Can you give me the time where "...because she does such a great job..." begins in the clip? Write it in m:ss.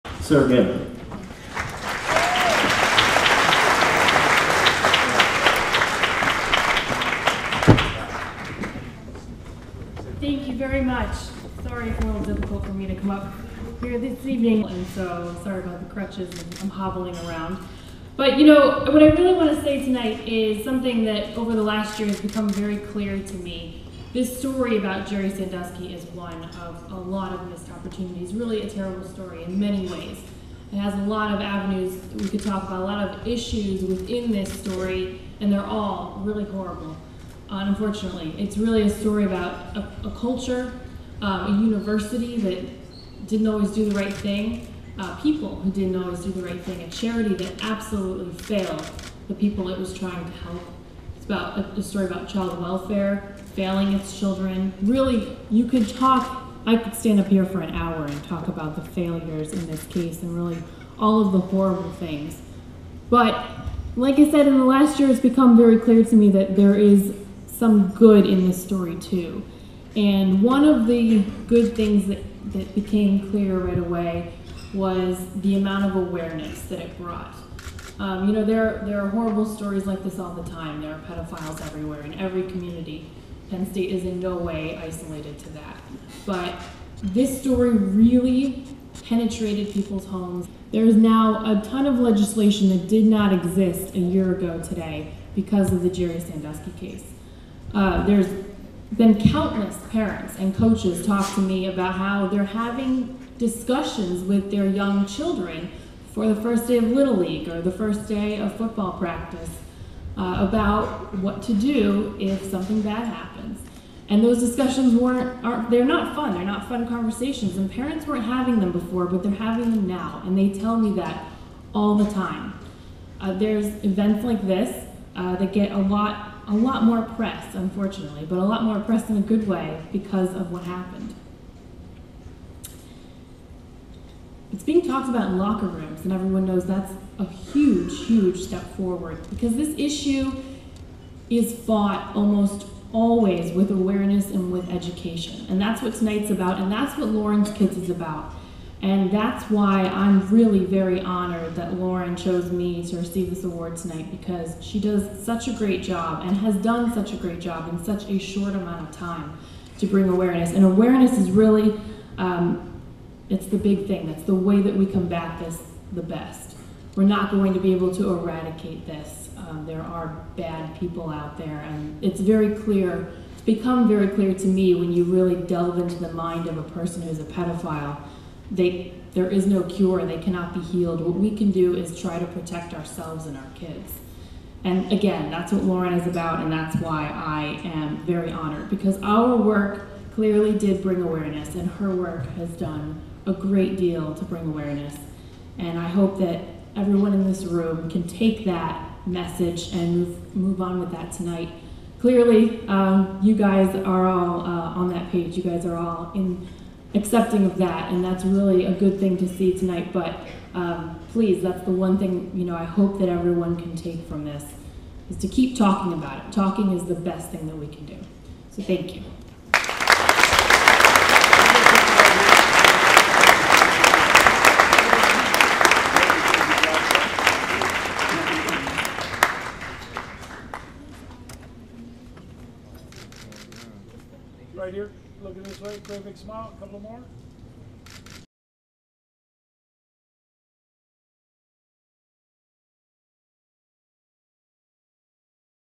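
2:34.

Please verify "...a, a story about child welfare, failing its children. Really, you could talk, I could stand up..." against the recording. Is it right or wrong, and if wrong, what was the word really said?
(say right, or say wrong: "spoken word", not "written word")
right.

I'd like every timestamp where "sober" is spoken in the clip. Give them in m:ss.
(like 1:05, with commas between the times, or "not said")
not said.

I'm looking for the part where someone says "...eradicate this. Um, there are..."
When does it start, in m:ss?
2:48.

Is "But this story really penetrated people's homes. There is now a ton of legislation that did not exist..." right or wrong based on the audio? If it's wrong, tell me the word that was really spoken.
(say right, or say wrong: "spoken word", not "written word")
right.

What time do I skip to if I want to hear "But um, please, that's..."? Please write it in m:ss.
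3:29.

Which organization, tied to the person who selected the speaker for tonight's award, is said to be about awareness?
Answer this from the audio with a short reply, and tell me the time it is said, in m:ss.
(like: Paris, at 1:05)
Lauren's Kids, at 2:27.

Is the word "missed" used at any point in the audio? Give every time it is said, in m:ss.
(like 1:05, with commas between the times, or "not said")
0:27.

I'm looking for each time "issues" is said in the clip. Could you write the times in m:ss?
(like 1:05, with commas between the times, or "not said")
0:33, 2:19.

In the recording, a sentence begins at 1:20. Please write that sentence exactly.
There are pedophiles everywhere in every community.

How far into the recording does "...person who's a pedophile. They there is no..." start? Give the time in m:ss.
2:56.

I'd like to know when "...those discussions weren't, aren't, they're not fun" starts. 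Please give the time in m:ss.
1:54.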